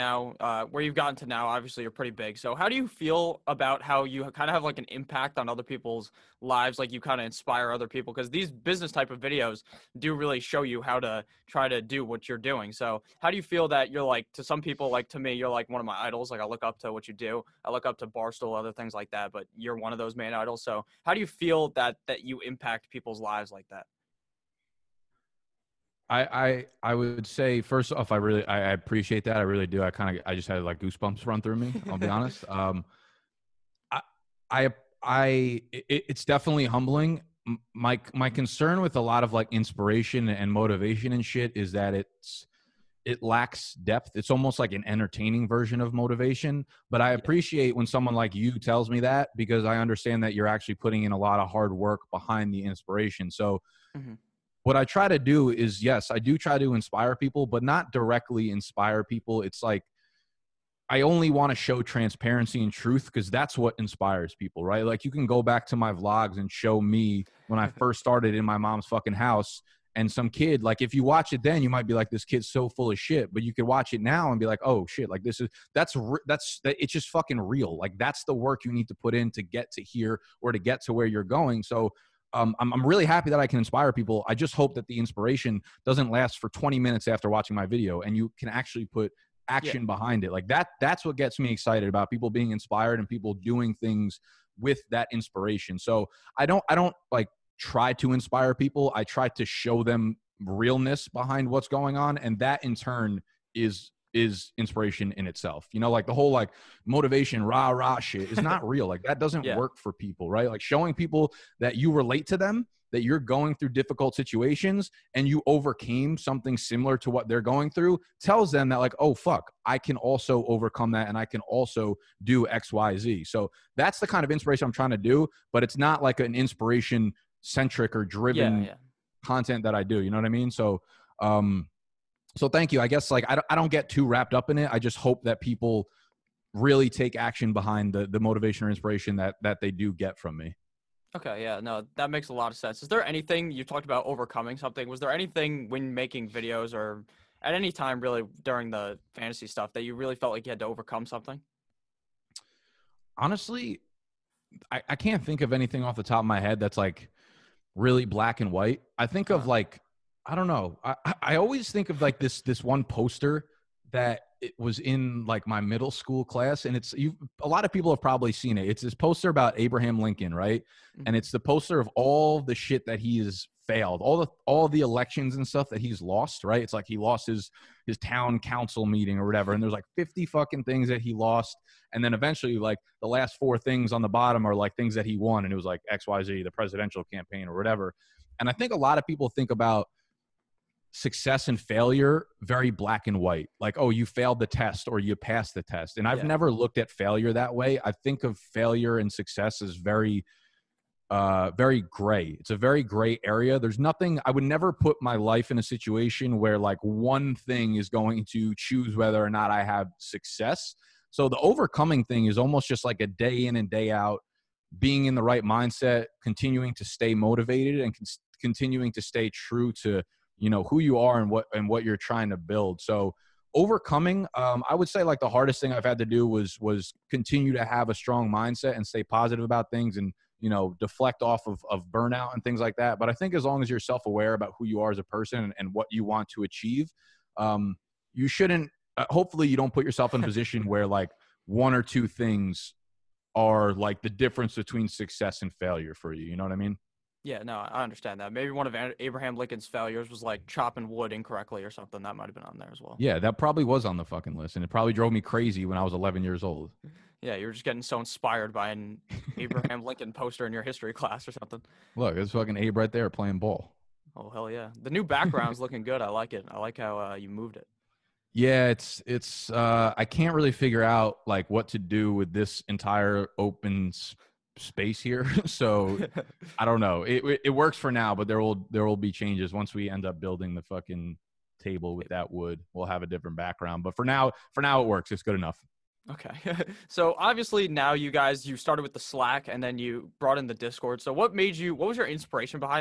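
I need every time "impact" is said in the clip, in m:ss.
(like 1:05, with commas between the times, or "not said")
0:04, 0:22.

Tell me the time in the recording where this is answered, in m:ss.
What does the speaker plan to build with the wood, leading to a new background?
4:41.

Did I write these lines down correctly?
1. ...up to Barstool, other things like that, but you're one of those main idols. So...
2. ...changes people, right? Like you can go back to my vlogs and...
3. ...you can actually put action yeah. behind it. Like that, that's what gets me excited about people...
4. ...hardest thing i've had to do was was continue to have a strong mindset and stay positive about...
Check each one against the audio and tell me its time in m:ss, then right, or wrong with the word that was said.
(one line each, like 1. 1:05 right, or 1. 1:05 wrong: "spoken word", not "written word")
1. 0:17 right
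2. 1:03 wrong: "inspires", not "changes"
3. 1:28 right
4. 3:45 right.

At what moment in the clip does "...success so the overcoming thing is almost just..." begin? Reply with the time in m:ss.
3:29.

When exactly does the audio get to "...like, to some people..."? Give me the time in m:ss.
0:14.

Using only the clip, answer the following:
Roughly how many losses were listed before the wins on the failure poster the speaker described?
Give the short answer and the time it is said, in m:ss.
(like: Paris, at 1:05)
50, at 2:59.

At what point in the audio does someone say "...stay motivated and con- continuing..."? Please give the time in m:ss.
3:36.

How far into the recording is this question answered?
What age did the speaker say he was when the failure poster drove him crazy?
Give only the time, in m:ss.
4:15.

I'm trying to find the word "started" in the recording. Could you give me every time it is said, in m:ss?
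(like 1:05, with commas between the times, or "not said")
1:08, 4:48.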